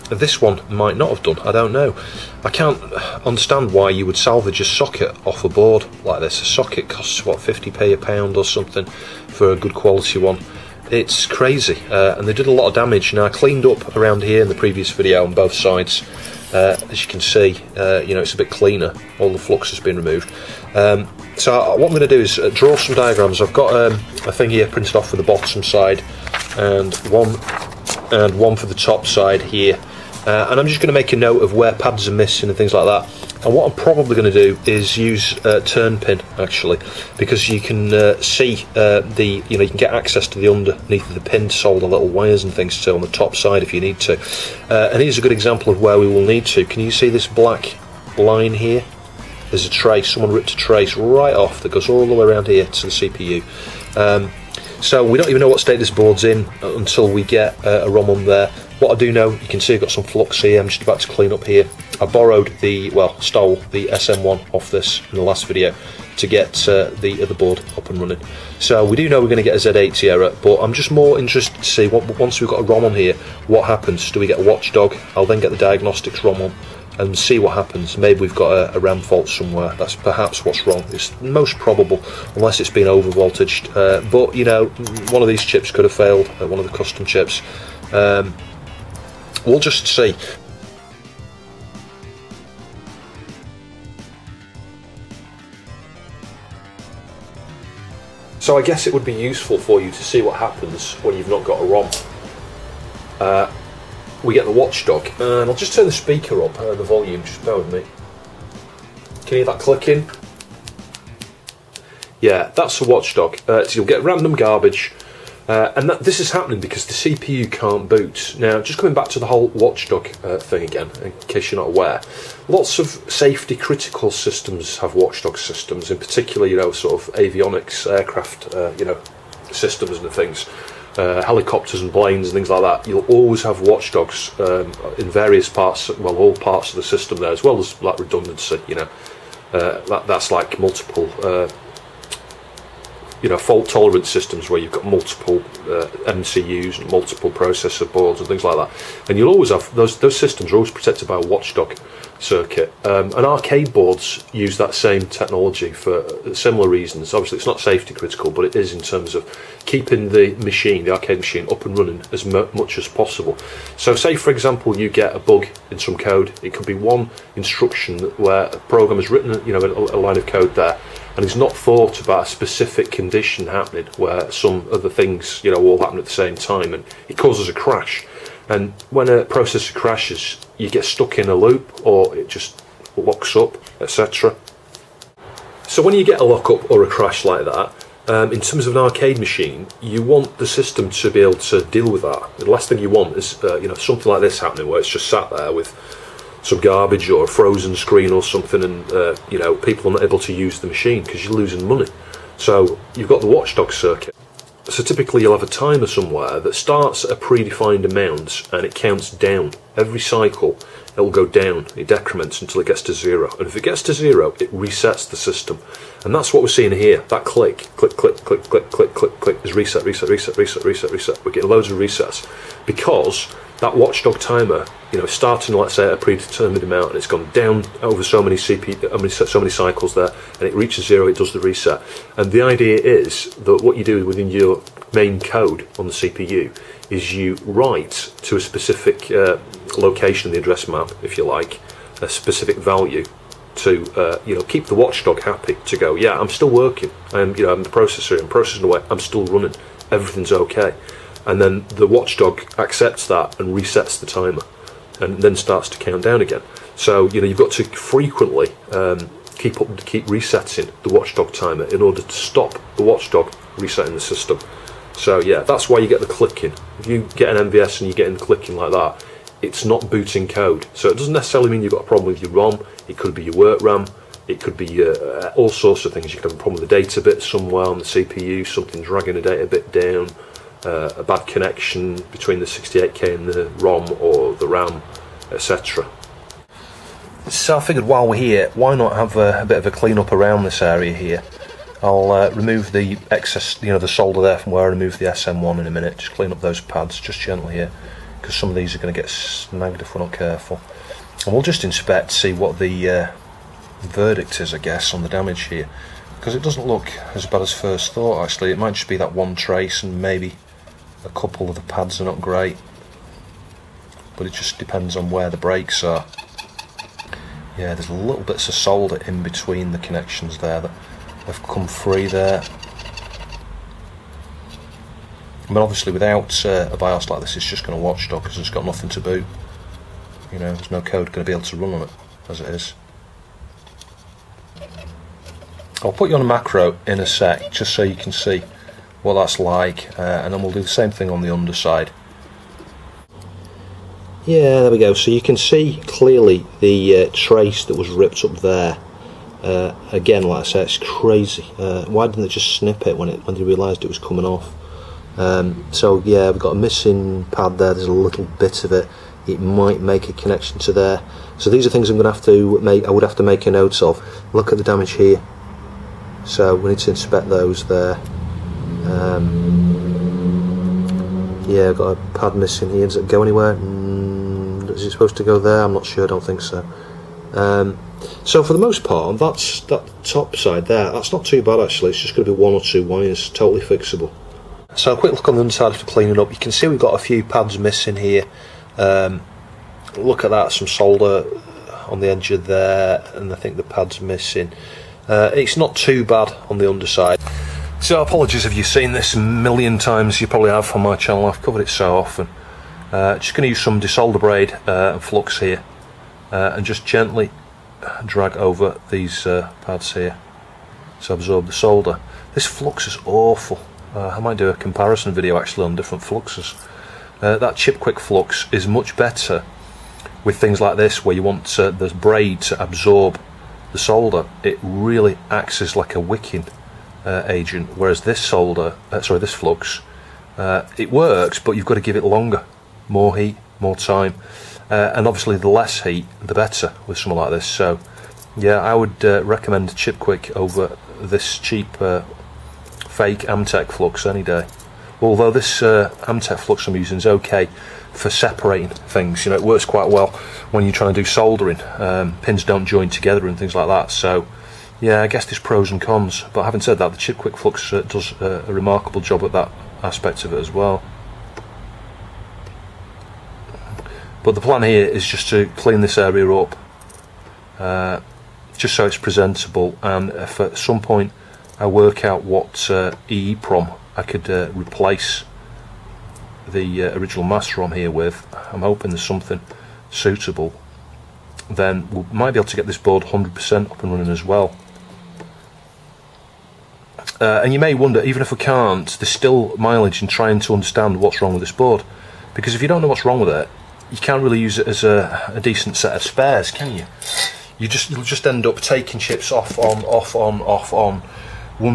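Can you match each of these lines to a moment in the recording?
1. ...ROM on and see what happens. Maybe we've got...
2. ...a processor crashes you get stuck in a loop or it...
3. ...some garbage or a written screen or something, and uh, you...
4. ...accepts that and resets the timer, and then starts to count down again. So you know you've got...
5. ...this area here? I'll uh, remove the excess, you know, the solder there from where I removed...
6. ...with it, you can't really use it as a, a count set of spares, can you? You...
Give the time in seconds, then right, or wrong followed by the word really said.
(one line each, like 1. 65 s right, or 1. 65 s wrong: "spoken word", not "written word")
1. 76 s right
2. 179 s right
3. 196 s wrong: "frozen", not "written"
4. 252 s right
5. 290 s right
6. 493 s wrong: "decent", not "count".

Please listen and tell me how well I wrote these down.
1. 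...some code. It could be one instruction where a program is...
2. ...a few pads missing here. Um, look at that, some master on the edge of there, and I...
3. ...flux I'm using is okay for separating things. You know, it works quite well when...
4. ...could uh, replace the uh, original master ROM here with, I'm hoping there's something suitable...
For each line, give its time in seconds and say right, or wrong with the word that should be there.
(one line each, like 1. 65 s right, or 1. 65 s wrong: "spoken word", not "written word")
1. 165 s right
2. 386 s wrong: "solder", not "master"
3. 446 s right
4. 474 s right.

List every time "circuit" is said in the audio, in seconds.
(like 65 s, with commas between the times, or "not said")
152 s, 203 s.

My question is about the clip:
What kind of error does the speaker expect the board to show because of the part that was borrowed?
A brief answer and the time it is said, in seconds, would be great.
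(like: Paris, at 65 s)
Z80 error, at 69 s.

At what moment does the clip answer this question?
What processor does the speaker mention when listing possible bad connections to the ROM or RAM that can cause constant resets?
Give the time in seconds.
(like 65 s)
282 s.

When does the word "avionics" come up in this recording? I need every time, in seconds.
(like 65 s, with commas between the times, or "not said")
127 s.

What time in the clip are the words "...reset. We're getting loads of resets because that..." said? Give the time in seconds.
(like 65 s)
220 s.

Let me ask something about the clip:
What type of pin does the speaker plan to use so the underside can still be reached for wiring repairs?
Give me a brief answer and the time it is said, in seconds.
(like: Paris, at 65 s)
turn pin, at 35 s.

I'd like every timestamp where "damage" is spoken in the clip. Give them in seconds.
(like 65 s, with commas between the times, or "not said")
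12 s, 305 s, 364 s.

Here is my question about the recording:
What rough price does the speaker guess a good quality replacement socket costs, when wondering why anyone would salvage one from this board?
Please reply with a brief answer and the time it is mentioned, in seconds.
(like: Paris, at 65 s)
50p, at 7 s.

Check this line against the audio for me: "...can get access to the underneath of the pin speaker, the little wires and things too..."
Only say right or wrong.
wrong.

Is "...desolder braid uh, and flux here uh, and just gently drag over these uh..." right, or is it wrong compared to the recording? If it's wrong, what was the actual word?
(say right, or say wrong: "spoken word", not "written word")
right.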